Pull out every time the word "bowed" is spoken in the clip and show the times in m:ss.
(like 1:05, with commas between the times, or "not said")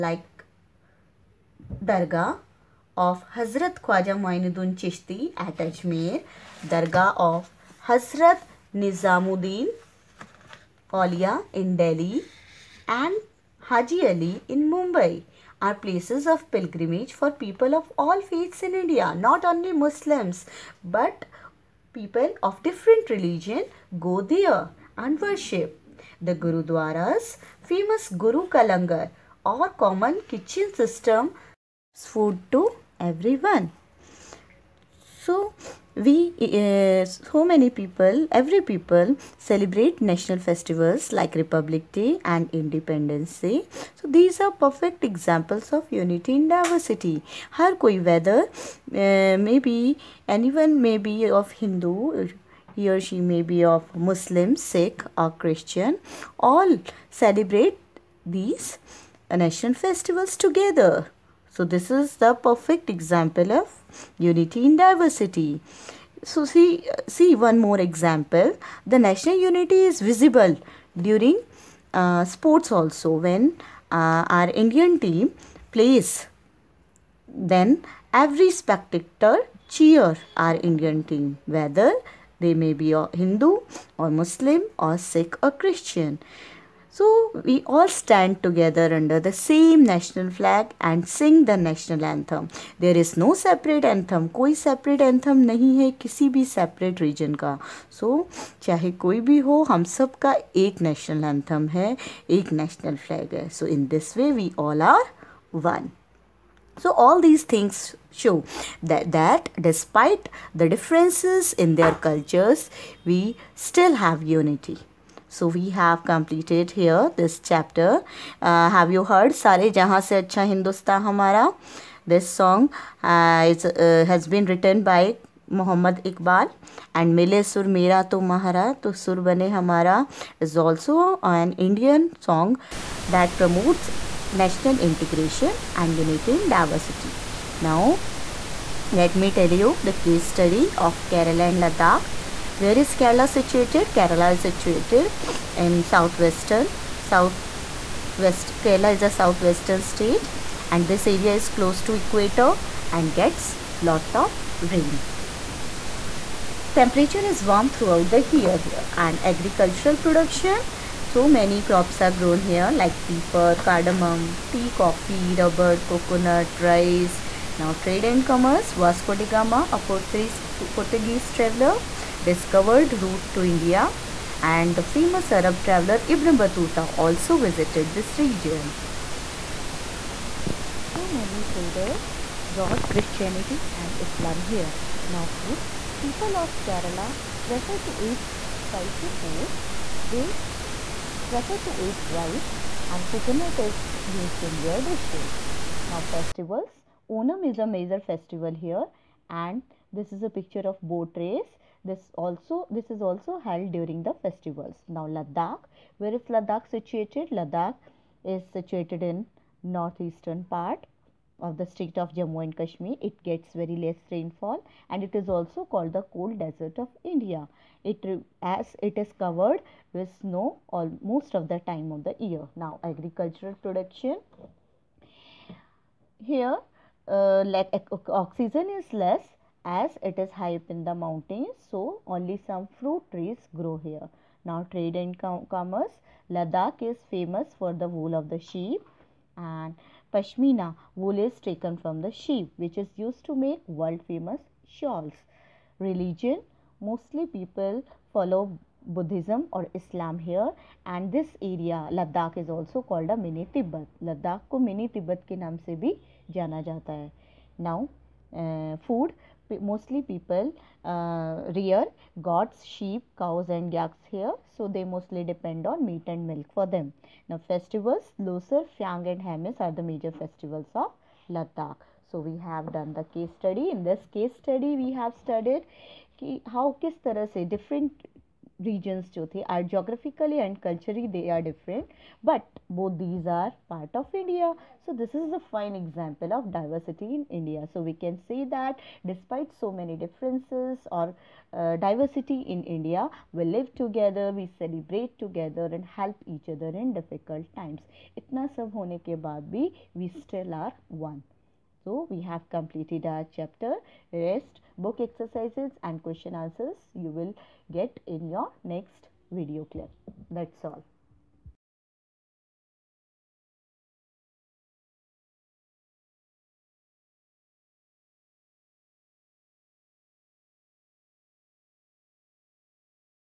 not said.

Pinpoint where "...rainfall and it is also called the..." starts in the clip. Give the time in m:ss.
3:34.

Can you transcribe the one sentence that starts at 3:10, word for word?
They prefer to eat rice and coconut is used in their dishes.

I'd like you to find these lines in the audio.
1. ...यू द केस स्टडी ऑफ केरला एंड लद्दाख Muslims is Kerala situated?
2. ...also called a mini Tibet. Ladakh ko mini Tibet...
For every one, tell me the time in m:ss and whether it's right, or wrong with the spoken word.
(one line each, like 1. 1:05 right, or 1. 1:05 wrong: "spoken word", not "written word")
1. 2:19 wrong: "Where", not "Muslims"
2. 4:12 right.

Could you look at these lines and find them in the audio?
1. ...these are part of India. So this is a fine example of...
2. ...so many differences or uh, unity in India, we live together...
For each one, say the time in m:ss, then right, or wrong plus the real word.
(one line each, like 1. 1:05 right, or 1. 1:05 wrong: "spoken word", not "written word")
1. 4:43 right
2. 4:49 wrong: "diversity", not "unity".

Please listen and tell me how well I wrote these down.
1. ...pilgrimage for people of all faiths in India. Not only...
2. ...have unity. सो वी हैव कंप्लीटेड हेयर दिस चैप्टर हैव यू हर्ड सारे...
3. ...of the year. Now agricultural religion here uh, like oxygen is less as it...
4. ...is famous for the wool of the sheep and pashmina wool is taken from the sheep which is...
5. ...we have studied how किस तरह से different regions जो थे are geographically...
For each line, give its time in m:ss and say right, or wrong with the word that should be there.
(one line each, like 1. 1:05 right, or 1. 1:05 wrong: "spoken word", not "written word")
1. 0:16 right
2. 1:54 right
3. 3:41 wrong: "production", not "religion"
4. 3:56 right
5. 4:34 right.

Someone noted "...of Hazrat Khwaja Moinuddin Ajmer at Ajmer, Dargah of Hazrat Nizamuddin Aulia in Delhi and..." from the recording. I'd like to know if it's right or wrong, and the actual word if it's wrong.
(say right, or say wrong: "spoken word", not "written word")
wrong: "Chishti", not "Ajmer".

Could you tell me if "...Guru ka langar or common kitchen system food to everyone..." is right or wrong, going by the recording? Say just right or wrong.
right.